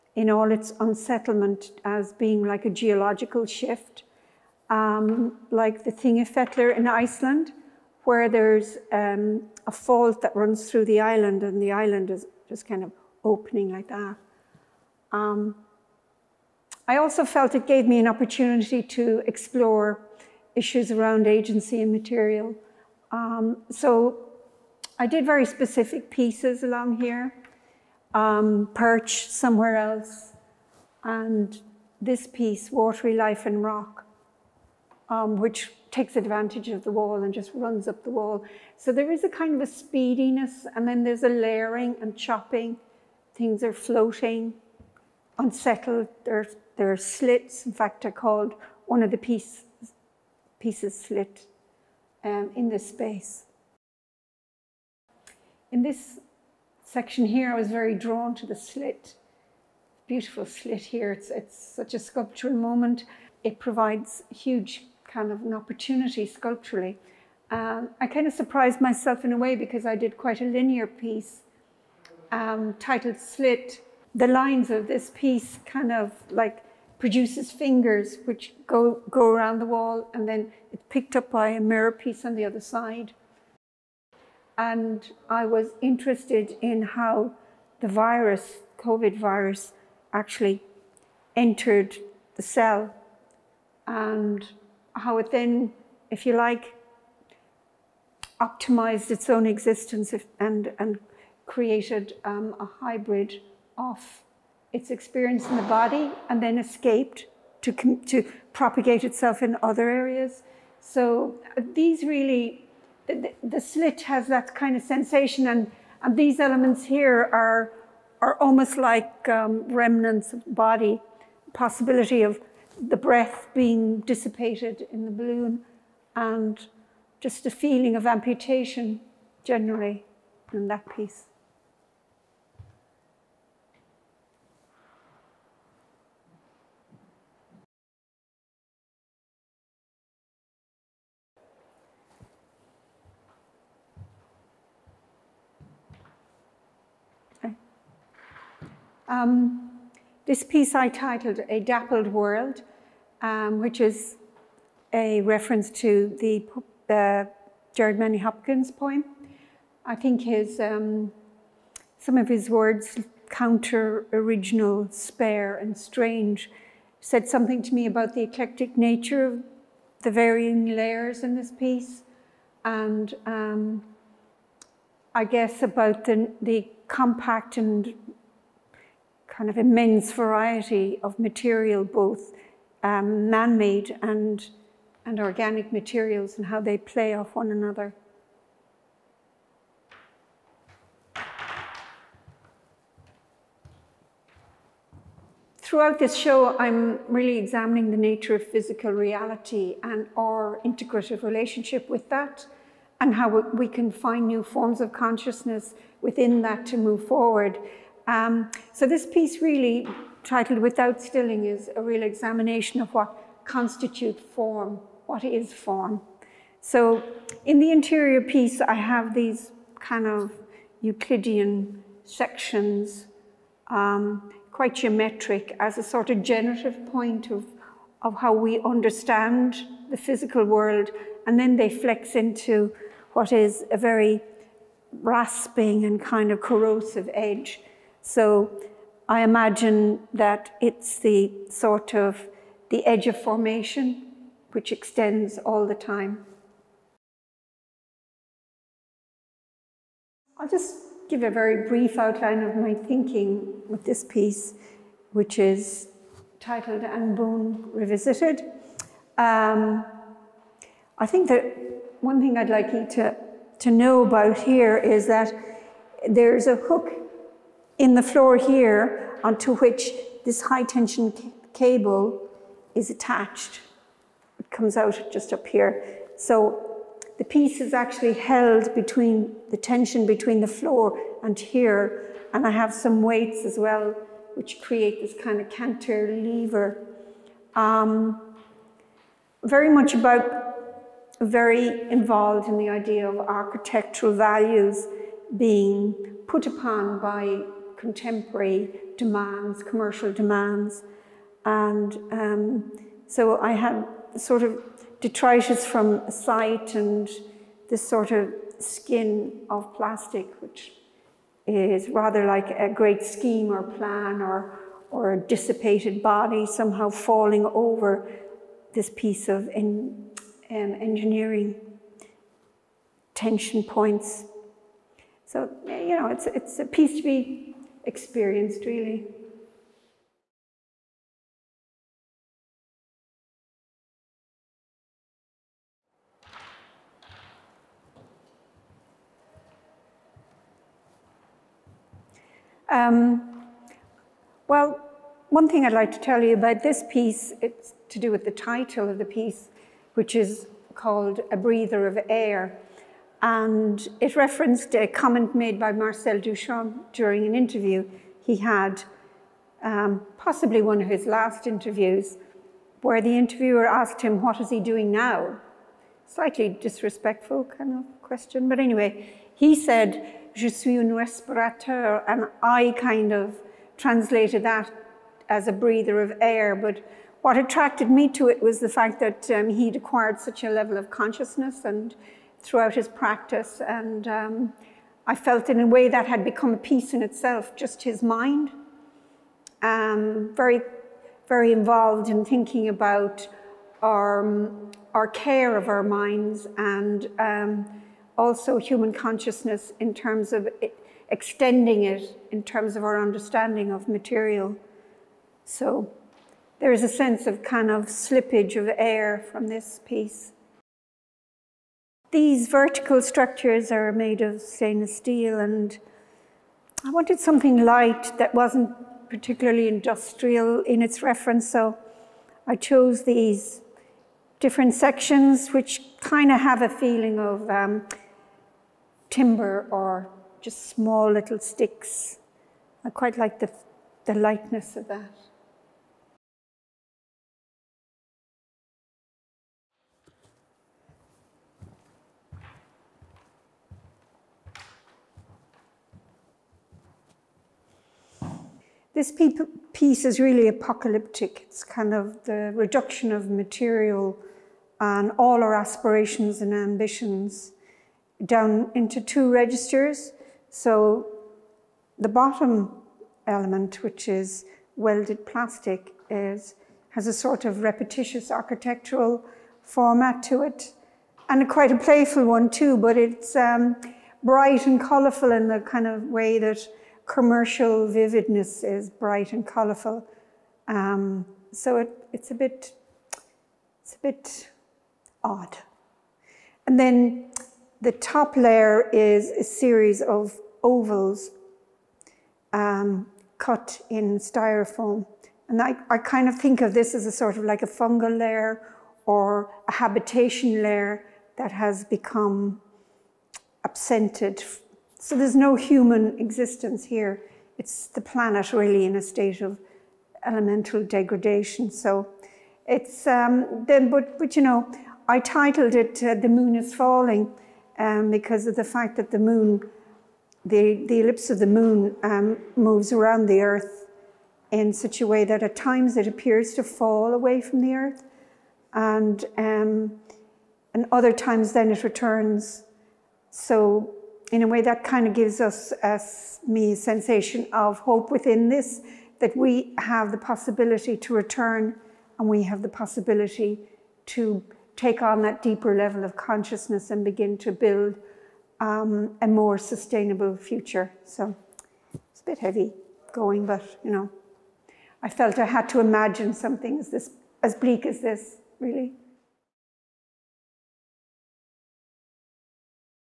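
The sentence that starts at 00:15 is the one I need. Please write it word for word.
Um, I also felt it gave me an opportunity to explore issues around agency and material.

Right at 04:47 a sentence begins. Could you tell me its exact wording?
Um, very much about very involved in the idea of architectural values being put upon by contemporary demands, commercial demands.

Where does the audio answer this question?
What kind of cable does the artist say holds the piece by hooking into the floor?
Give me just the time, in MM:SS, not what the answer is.
04:30.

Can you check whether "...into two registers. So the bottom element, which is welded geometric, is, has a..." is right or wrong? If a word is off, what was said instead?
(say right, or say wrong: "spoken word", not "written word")
wrong: "plastic", not "geometric".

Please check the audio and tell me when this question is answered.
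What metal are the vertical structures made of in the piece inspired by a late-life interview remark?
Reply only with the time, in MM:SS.
06:54.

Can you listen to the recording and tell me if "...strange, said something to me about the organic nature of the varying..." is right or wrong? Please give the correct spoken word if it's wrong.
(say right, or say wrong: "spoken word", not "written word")
wrong: "eclectic", not "organic".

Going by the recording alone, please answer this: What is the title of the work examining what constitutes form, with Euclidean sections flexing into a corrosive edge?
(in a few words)
Without Stilling.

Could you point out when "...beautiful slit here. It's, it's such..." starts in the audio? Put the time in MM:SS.
01:00.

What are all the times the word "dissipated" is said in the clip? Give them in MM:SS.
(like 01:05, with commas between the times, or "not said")
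02:04, 05:15.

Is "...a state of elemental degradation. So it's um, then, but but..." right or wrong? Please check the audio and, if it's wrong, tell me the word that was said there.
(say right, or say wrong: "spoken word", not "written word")
right.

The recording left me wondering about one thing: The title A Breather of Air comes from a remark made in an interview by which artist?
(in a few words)
Marcel Duchamp.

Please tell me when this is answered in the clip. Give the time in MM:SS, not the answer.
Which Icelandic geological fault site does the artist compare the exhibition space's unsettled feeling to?
00:05.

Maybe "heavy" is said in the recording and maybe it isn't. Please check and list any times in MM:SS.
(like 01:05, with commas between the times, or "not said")
09:12.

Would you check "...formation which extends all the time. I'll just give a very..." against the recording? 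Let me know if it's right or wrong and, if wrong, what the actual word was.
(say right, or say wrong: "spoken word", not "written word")
right.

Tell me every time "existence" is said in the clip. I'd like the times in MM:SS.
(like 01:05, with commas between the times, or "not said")
01:39, 08:26.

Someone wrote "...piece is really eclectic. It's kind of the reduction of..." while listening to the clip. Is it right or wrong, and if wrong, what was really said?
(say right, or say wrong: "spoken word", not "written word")
wrong: "apocalyptic", not "eclectic".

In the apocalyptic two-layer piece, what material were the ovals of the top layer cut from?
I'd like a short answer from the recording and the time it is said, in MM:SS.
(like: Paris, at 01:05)
styrofoam, at 08:14.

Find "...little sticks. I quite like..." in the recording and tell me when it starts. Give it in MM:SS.
07:11.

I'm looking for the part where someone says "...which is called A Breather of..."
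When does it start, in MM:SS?
05:49.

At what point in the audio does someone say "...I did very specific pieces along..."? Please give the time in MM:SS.
00:25.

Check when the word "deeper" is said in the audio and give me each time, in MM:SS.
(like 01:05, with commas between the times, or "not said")
09:05.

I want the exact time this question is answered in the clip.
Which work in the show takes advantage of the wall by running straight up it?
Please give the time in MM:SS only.
00:32.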